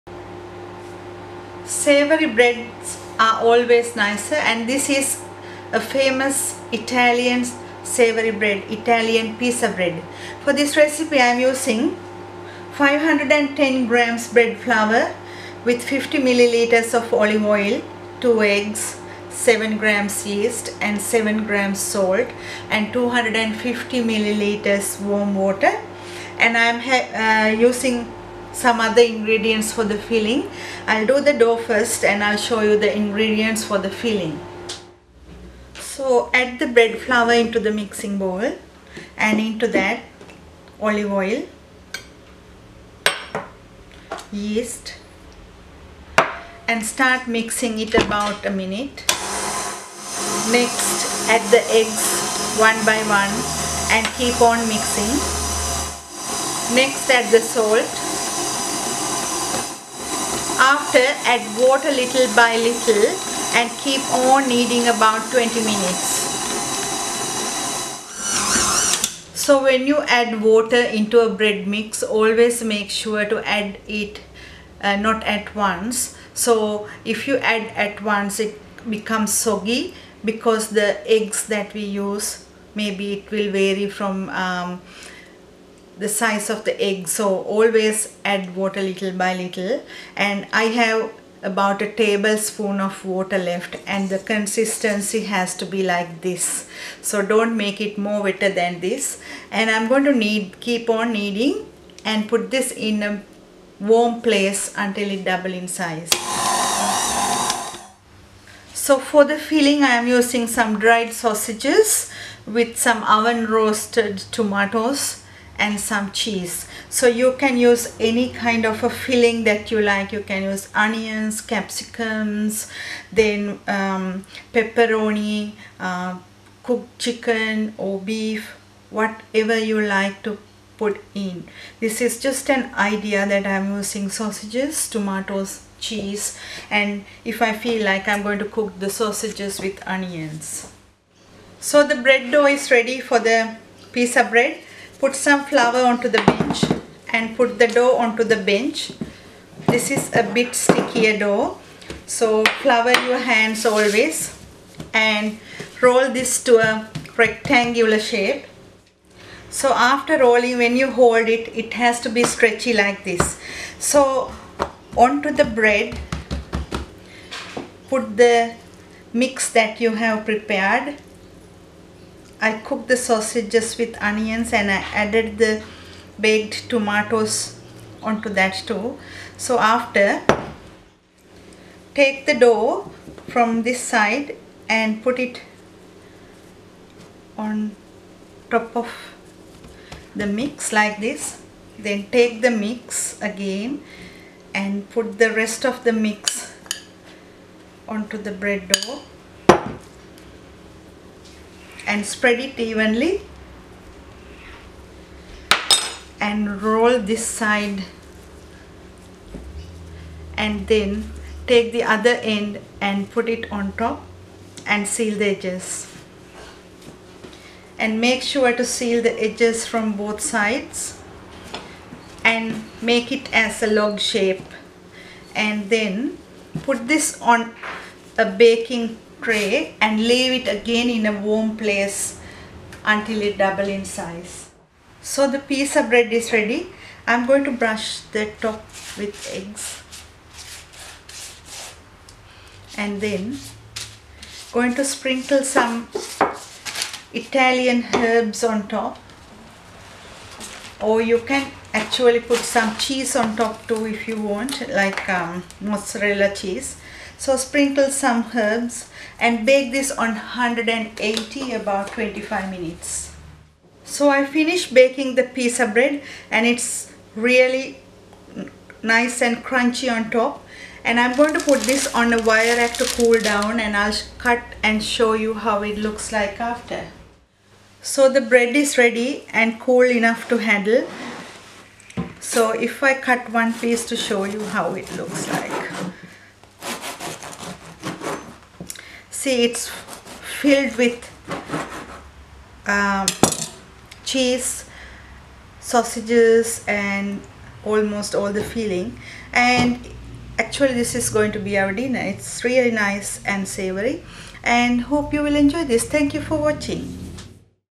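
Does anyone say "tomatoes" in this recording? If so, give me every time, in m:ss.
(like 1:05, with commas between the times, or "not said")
1:54, 2:14, 2:56.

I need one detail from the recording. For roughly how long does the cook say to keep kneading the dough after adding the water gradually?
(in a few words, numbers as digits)
20 minutes.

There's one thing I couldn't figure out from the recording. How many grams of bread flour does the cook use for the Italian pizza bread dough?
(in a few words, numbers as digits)
510 grams.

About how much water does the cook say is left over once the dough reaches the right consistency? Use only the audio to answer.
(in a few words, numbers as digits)
a tablespoon.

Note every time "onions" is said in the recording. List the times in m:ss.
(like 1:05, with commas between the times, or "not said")
2:00, 2:19, 2:54.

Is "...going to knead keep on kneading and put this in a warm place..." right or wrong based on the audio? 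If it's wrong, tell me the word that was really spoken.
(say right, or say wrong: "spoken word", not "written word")
right.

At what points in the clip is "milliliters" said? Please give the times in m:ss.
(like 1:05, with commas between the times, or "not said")
0:16, 0:24.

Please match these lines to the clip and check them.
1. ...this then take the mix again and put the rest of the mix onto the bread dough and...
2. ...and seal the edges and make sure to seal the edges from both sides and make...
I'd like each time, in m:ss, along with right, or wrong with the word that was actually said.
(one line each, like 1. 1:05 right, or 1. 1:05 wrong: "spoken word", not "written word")
1. 3:10 right
2. 3:34 right.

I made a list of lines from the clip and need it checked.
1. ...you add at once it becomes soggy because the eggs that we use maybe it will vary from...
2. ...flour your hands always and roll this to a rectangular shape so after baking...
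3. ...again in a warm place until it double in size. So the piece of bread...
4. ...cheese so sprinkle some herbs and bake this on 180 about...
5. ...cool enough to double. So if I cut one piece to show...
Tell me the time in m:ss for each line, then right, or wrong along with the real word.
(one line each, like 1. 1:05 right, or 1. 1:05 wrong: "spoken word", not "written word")
1. 1:17 right
2. 2:32 wrong: "rolling", not "baking"
3. 3:50 right
4. 4:16 right
5. 4:39 wrong: "handle", not "double".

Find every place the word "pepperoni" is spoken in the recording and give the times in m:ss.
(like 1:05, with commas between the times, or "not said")
2:04.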